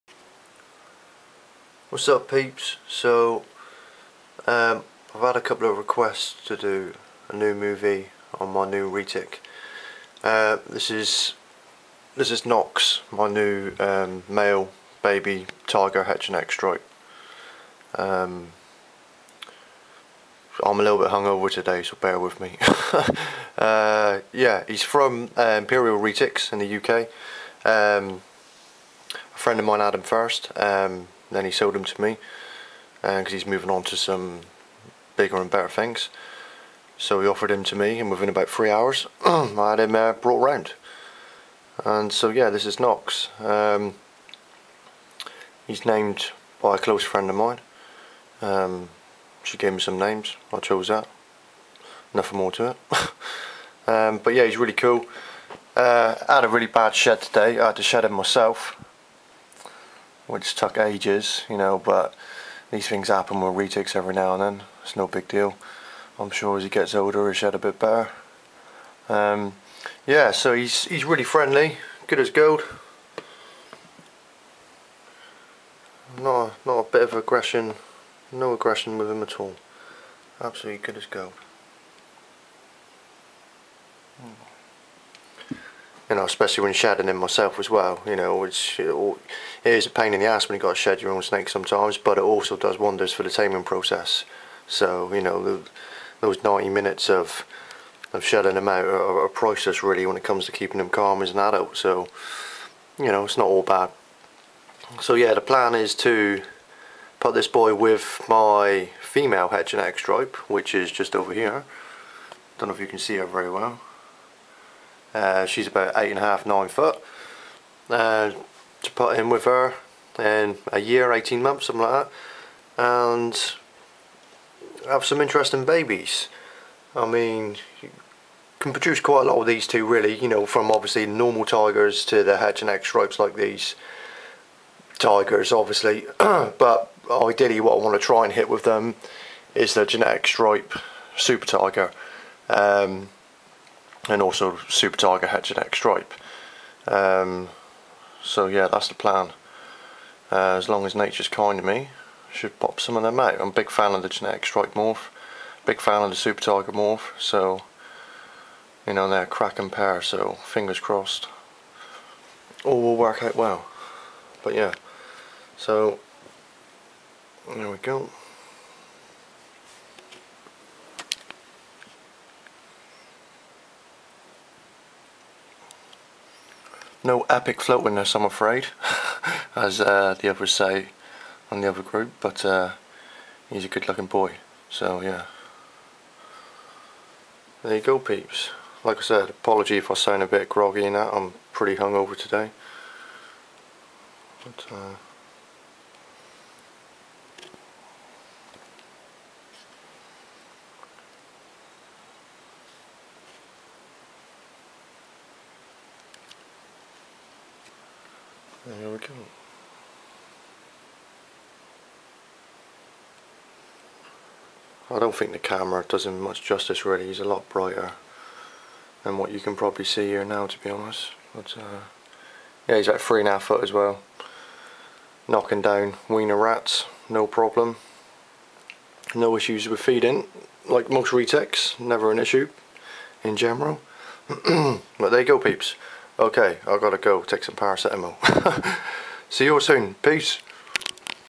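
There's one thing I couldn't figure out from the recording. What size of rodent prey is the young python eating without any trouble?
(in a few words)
Wiener rats.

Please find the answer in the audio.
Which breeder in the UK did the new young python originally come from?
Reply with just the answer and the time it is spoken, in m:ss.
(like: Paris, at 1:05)
Imperial Retics, at 0:25.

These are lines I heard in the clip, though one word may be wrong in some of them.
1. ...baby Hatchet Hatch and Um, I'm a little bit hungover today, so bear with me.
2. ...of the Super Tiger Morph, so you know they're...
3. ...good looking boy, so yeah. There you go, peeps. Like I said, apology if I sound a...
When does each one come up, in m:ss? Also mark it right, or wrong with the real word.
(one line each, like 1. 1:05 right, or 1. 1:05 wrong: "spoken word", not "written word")
1. 0:15 wrong: "Tiger", not "Hatchet"
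2. 2:36 right
3. 3:03 right.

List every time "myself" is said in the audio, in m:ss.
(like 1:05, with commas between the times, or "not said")
0:58, 1:27.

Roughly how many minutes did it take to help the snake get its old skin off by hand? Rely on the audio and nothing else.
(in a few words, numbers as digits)
90.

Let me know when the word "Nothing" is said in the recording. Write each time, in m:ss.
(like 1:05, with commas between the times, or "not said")
0:52.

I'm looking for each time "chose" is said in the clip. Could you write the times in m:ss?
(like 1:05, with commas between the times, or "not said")
0:50.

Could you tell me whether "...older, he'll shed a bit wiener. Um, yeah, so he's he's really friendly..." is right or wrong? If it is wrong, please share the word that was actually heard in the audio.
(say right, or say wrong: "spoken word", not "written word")
wrong: "better", not "wiener".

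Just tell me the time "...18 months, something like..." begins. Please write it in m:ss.
2:01.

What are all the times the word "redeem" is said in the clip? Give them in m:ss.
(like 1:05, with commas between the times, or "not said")
not said.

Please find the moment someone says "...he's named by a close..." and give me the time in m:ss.
0:45.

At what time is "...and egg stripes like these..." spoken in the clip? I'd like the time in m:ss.
2:12.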